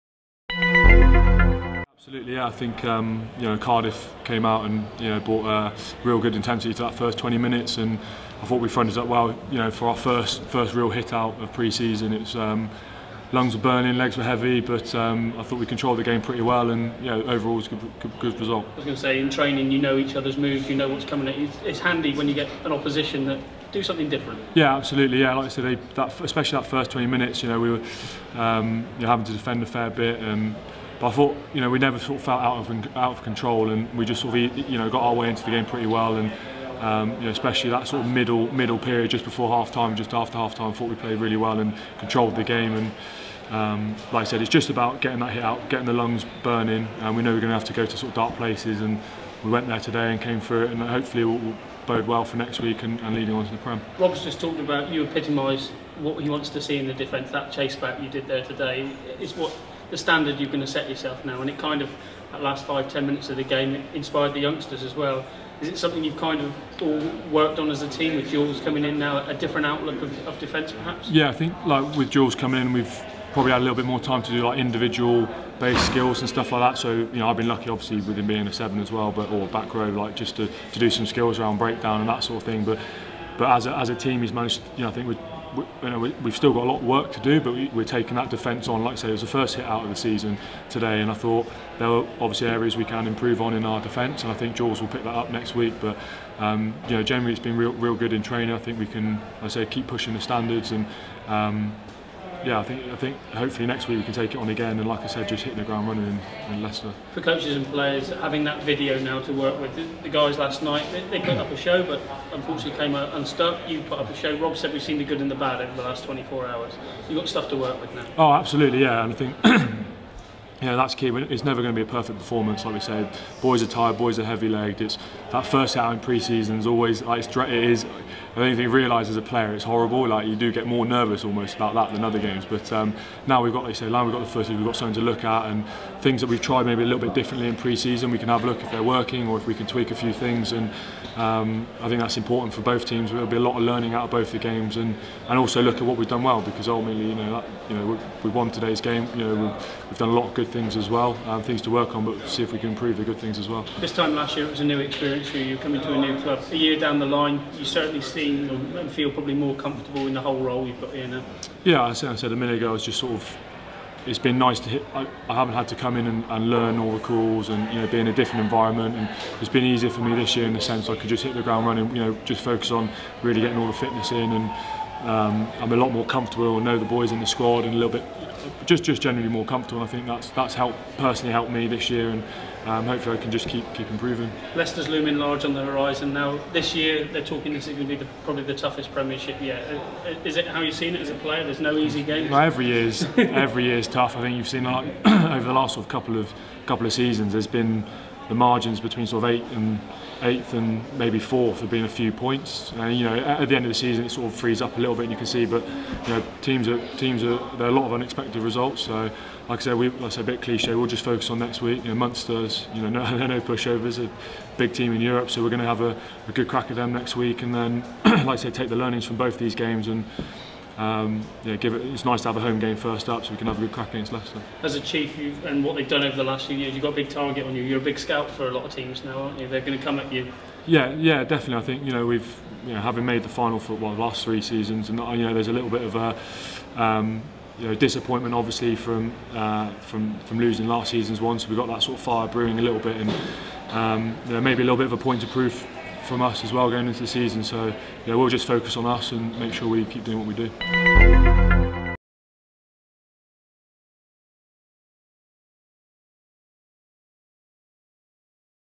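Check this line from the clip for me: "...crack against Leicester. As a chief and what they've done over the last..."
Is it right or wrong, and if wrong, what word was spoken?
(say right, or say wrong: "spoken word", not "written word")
right.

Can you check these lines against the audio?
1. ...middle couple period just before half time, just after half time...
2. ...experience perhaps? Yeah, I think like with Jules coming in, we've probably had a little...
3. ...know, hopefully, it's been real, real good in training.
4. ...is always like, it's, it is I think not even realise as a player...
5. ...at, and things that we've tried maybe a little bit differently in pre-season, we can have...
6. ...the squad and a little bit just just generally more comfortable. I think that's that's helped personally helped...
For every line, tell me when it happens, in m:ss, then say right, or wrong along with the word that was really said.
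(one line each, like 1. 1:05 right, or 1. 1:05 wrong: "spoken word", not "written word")
1. 0:38 wrong: "middle", not "couple"
2. 1:10 wrong: "defence", not "experience"
3. 1:36 wrong: "generally", not "hopefully"
4. 2:06 right
5. 2:15 right
6. 2:57 right.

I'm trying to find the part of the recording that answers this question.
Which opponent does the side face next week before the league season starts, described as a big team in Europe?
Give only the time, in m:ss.
3:31.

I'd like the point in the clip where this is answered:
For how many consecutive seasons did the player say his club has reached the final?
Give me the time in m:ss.
3:54.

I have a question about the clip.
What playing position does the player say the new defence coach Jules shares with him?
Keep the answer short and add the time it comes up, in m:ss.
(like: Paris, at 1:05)
seven, at 1:18.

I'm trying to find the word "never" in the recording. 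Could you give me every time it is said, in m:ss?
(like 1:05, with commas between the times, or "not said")
0:31, 2:01.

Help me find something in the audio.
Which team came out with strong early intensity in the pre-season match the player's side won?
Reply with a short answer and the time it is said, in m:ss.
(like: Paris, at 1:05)
Cardiff, at 0:03.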